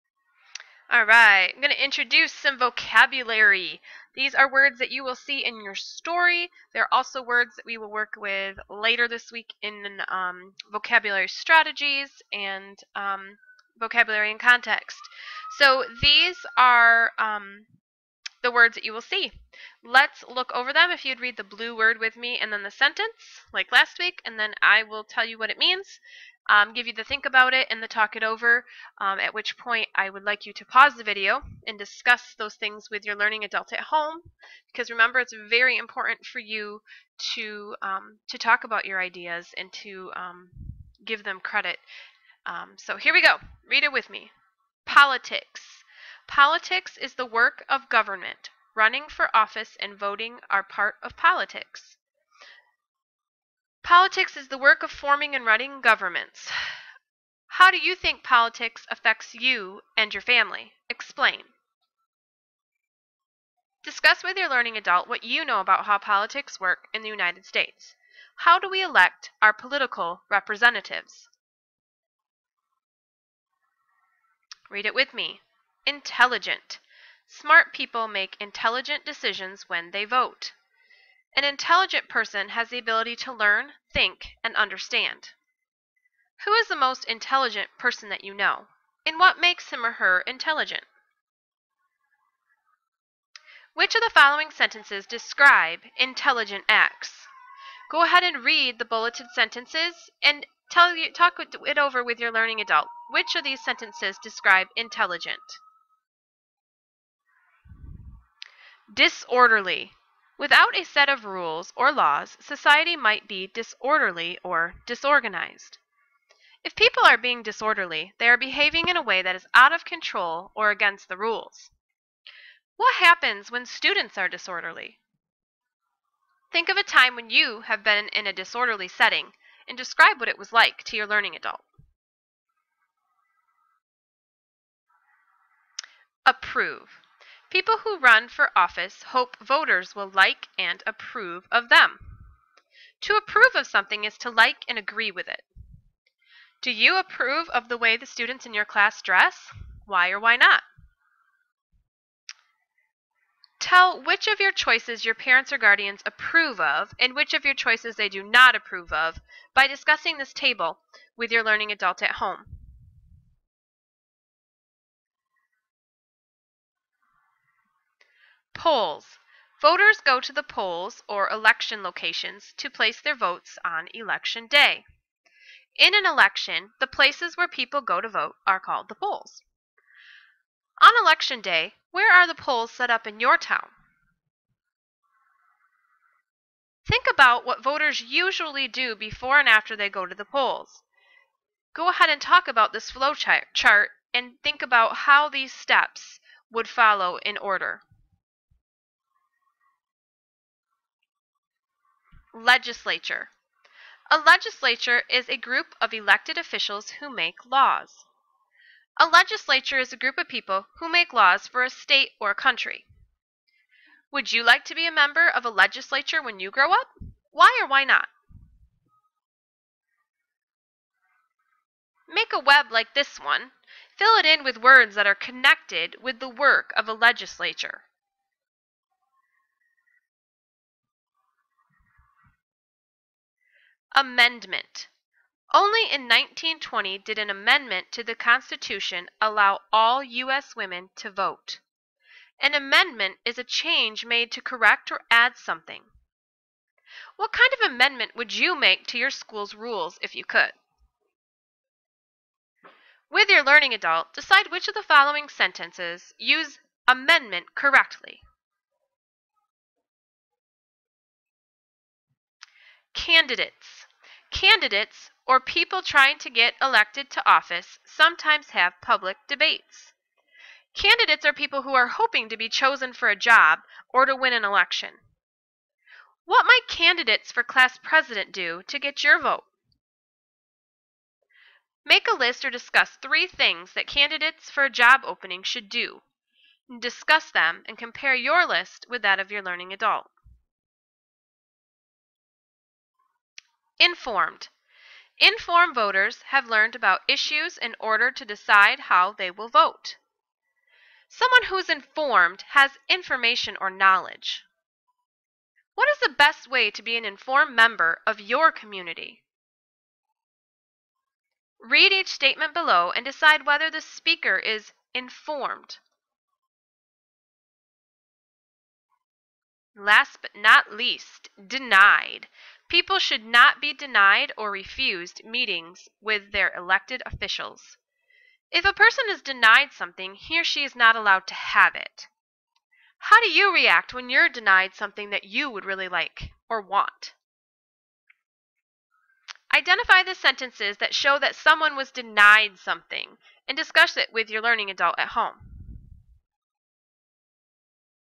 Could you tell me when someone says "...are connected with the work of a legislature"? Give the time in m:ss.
3:45.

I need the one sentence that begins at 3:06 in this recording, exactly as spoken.
Think about what voters usually do before and after they go to the polls.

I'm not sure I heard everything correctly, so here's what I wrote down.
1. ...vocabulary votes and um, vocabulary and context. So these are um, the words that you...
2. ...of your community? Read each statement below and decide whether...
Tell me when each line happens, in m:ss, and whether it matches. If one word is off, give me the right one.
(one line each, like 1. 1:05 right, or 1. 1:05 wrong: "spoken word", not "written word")
1. 0:10 wrong: "strategies", not "votes"
2. 5:08 right.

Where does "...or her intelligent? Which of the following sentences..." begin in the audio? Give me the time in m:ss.
1:29.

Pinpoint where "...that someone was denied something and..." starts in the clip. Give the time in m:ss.
5:41.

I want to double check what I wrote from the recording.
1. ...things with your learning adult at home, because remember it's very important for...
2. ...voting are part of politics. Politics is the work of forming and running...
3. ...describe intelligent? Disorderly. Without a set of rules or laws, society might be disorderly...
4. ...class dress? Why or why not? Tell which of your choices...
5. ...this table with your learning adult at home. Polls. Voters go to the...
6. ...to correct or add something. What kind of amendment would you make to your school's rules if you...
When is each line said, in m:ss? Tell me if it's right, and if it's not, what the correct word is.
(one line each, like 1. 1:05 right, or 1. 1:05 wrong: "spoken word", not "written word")
1. 0:32 right
2. 0:49 right
3. 1:44 right
4. 2:28 right
5. 2:40 right
6. 4:04 right.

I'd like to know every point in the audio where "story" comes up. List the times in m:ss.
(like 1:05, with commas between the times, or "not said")
0:05.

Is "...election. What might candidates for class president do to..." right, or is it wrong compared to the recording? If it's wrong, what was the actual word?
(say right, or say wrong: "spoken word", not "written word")
right.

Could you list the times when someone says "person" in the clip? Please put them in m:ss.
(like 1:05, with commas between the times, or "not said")
1:22, 1:27, 5:28.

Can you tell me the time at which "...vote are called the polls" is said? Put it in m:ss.
2:58.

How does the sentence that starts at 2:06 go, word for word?
Think of a time when you have been in a disorderly setting and describe what it was like to your learning adult.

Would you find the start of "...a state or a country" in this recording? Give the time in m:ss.
3:31.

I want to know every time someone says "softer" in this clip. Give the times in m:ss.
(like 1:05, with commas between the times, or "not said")
not said.